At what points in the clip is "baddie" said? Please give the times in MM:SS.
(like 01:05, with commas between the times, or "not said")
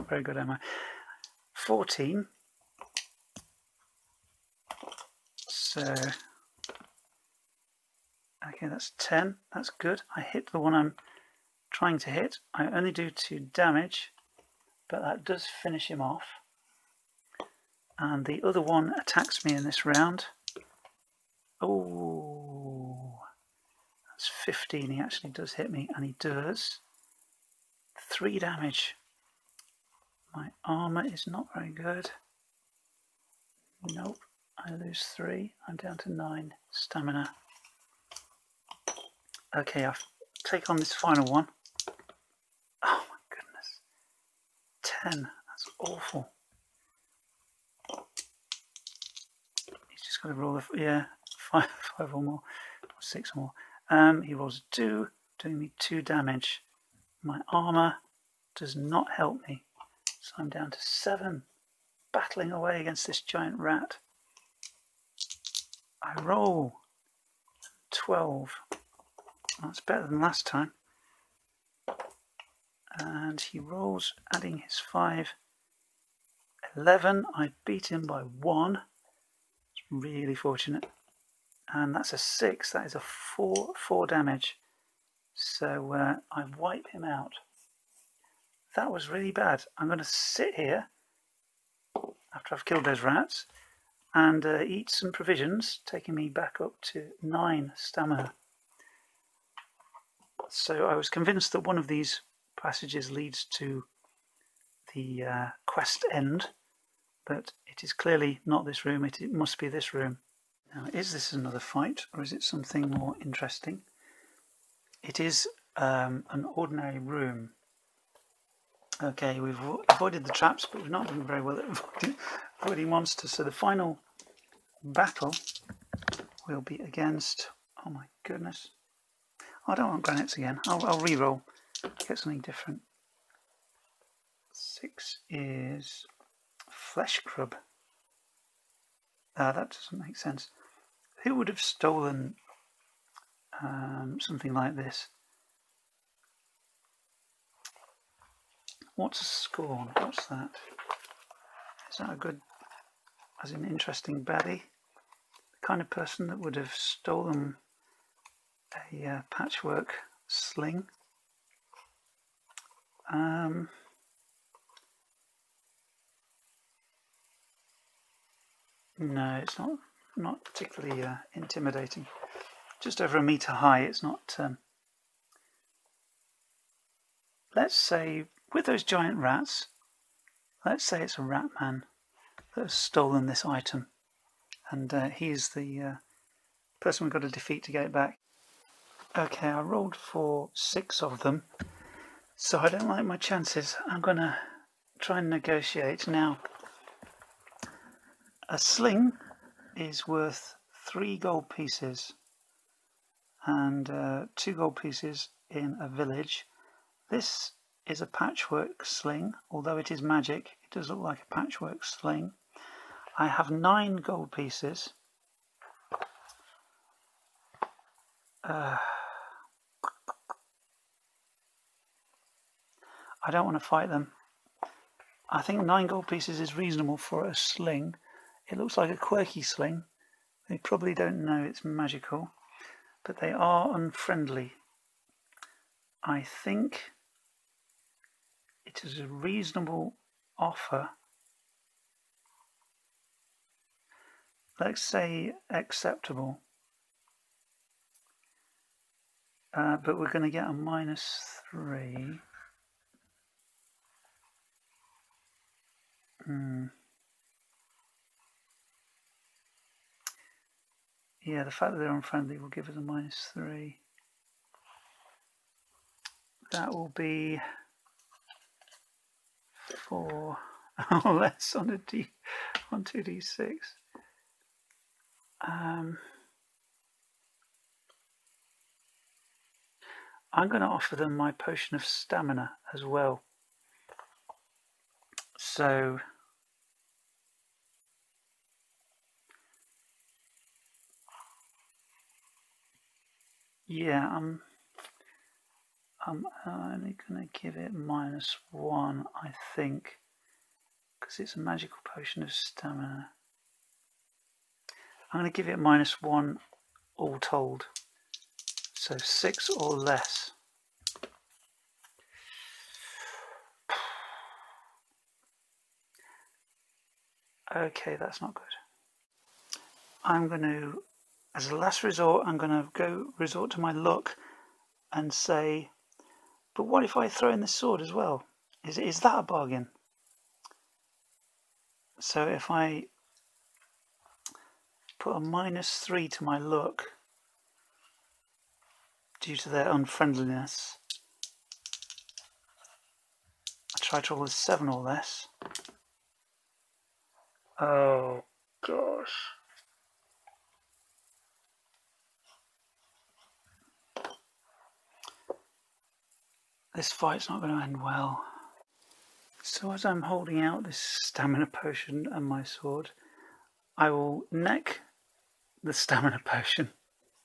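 02:34.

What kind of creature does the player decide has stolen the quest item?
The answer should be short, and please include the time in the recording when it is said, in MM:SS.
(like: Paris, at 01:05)
rat man, at 03:01.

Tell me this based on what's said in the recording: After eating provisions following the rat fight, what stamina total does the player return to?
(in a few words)
9.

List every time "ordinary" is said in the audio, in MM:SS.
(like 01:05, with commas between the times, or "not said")
01:56.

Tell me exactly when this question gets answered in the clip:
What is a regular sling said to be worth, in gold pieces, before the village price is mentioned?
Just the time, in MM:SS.
03:20.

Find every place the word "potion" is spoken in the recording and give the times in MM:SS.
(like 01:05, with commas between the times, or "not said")
04:41, 05:01, 06:01, 06:06.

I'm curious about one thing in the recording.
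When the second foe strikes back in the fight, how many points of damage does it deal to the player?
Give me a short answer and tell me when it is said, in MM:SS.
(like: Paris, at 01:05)
3, at 00:26.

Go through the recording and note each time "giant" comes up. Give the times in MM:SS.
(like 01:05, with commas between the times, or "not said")
01:03, 02:58.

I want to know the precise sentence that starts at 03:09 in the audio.
Okay, I rolled for six of them, so I don't like my chances.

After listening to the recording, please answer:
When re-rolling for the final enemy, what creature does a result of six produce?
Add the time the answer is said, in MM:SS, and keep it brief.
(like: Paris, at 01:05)
flesh grub, at 02:14.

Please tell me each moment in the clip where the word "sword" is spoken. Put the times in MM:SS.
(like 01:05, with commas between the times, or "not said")
05:27, 06:02.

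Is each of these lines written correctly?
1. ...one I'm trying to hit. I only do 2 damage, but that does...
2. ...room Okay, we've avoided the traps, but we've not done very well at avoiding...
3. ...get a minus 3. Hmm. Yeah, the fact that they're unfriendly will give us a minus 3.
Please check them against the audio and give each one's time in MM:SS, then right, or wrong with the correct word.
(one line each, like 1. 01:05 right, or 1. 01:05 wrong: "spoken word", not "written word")
1. 00:10 right
2. 01:56 right
3. 04:10 right.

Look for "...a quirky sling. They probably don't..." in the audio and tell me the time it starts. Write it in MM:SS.
03:48.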